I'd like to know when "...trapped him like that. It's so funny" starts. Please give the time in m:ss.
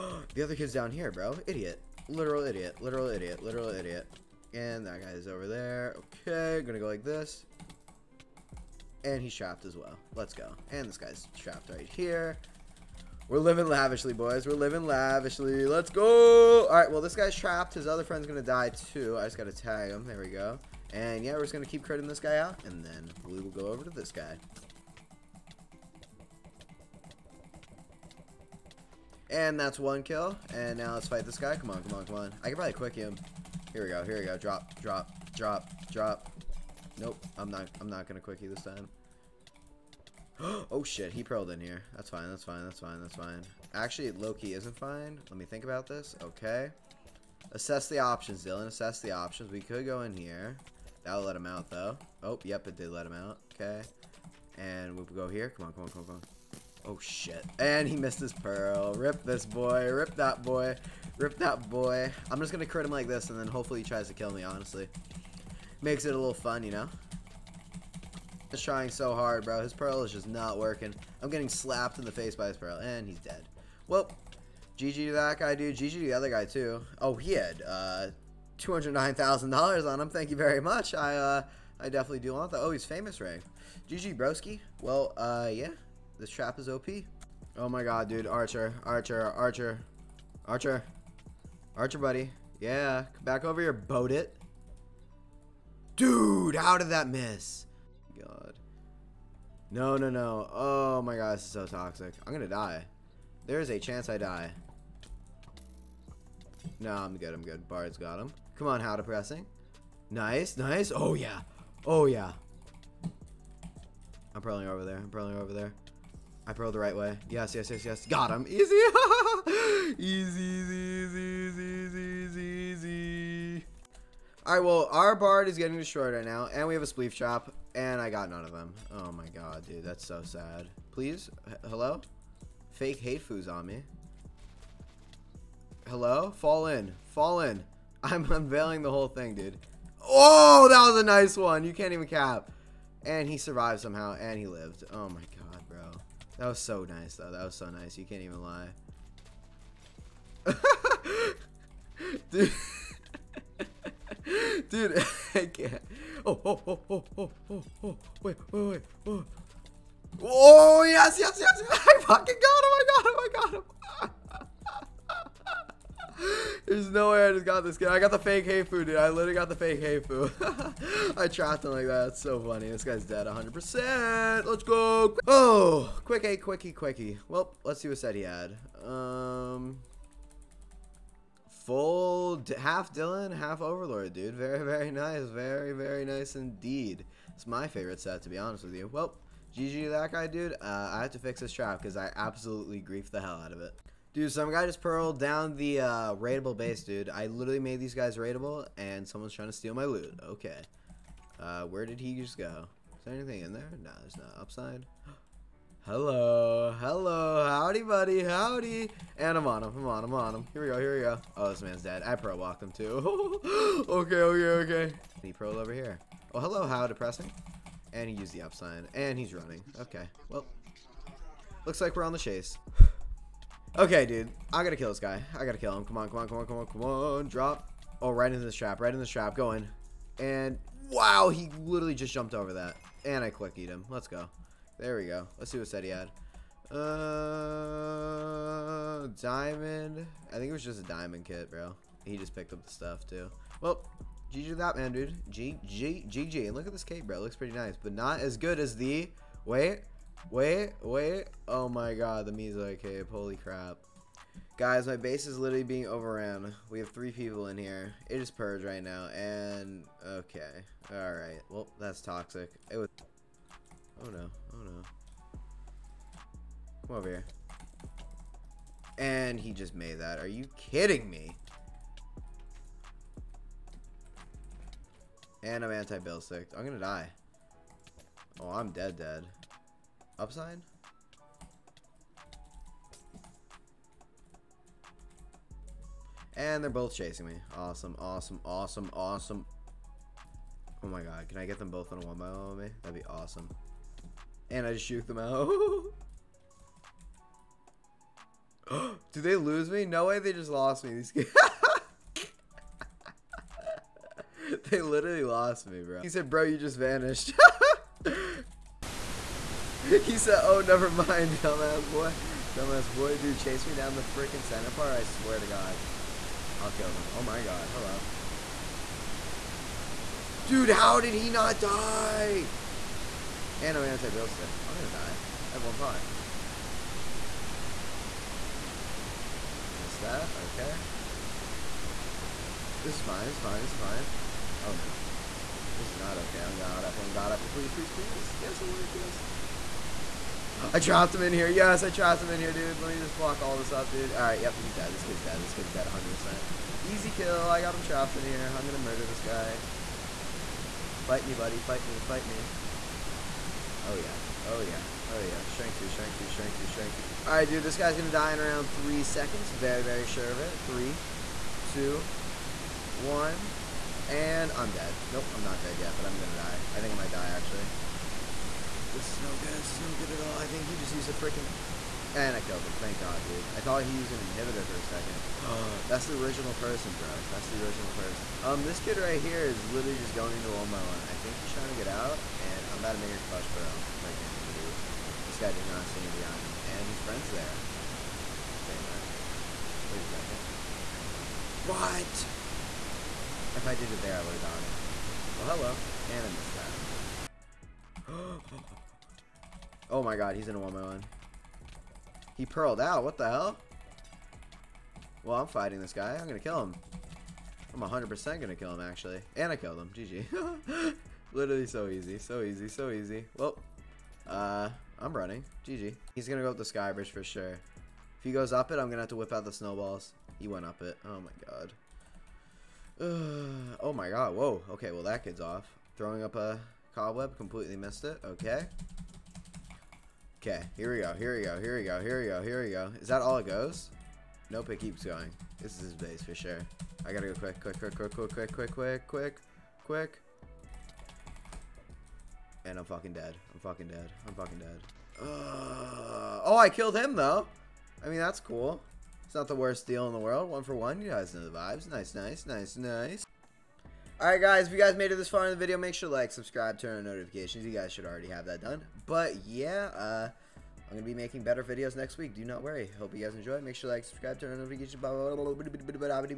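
2:51.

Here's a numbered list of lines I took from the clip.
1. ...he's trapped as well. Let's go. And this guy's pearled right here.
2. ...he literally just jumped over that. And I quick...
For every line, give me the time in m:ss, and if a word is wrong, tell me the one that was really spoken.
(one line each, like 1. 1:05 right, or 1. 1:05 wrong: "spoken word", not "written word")
1. 0:09 wrong: "trapped", not "pearled"
2. 3:51 right.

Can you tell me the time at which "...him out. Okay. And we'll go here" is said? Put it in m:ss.
0:53.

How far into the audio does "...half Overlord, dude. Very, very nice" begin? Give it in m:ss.
3:03.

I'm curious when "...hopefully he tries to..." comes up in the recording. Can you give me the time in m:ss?
1:03.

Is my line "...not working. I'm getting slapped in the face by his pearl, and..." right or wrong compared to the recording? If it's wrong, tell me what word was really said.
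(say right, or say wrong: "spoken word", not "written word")
right.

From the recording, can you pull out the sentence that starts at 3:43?
okay, dude, I gotta kill this guy.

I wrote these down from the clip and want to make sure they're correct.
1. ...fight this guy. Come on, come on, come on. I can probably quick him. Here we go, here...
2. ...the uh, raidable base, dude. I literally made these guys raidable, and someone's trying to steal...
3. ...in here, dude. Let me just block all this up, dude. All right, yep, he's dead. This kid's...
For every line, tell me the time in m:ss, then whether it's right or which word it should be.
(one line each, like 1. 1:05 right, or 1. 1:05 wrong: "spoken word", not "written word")
1. 0:31 right
2. 3:15 right
3. 5:42 right.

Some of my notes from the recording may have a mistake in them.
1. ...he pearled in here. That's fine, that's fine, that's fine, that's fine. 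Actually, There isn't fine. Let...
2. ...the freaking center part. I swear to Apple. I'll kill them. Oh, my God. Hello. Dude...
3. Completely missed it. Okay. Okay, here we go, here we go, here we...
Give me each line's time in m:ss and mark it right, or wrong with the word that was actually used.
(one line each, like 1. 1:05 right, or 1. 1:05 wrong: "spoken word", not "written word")
1. 0:41 wrong: "Loki", not "There"
2. 5:13 wrong: "God", not "Apple"
3. 7:07 right.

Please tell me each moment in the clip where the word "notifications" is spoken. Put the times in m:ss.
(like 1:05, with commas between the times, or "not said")
7:37, 7:44.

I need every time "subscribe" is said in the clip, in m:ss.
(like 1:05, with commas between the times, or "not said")
7:36, 7:44.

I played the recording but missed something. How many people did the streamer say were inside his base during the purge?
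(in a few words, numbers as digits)
3.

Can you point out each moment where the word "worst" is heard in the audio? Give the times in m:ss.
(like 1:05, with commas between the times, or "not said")
7:29.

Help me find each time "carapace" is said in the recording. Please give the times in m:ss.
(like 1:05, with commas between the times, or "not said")
not said.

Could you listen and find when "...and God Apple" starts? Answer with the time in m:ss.
5:37.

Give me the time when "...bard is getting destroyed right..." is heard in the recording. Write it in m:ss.
2:05.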